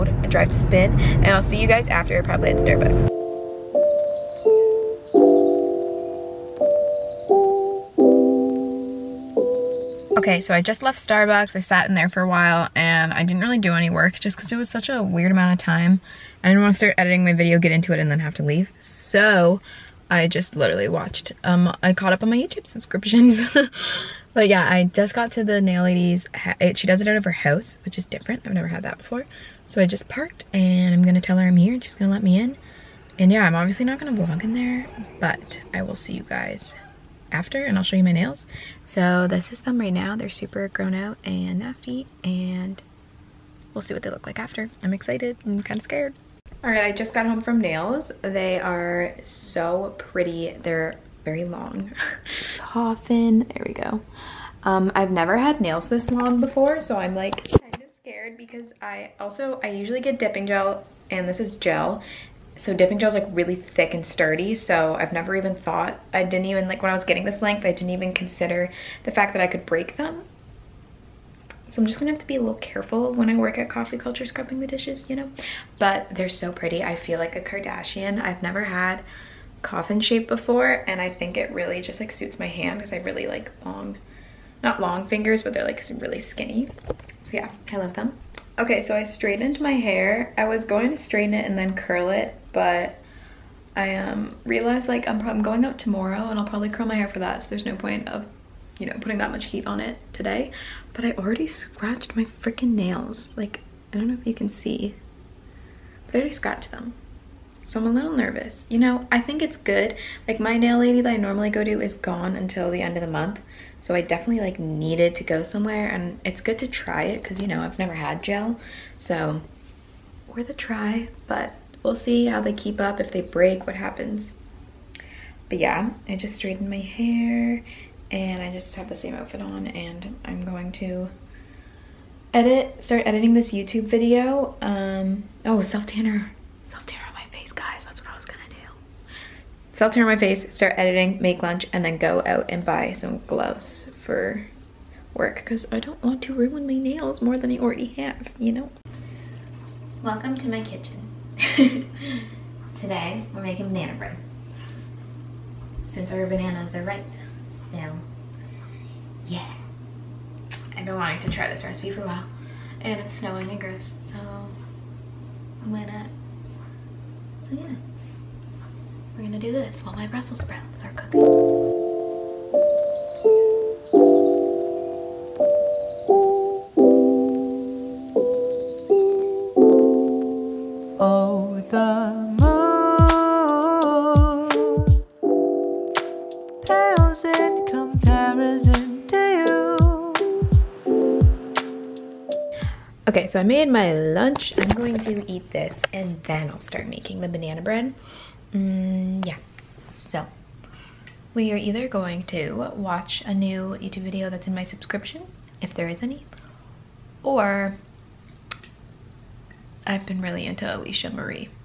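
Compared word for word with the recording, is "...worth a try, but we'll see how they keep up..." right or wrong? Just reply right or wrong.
right.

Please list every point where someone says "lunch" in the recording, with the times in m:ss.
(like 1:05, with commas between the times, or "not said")
2:21, 3:13.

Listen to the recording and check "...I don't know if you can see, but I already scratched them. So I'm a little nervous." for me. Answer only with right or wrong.
right.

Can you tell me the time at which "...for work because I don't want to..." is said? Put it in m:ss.
2:24.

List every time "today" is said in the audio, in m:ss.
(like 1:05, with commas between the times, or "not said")
1:40, 2:32.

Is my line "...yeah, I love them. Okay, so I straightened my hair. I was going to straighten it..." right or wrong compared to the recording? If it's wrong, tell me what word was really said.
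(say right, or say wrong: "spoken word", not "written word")
right.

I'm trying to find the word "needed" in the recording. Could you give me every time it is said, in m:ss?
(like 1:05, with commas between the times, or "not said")
1:54.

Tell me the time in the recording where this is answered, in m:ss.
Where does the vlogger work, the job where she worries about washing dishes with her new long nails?
1:13.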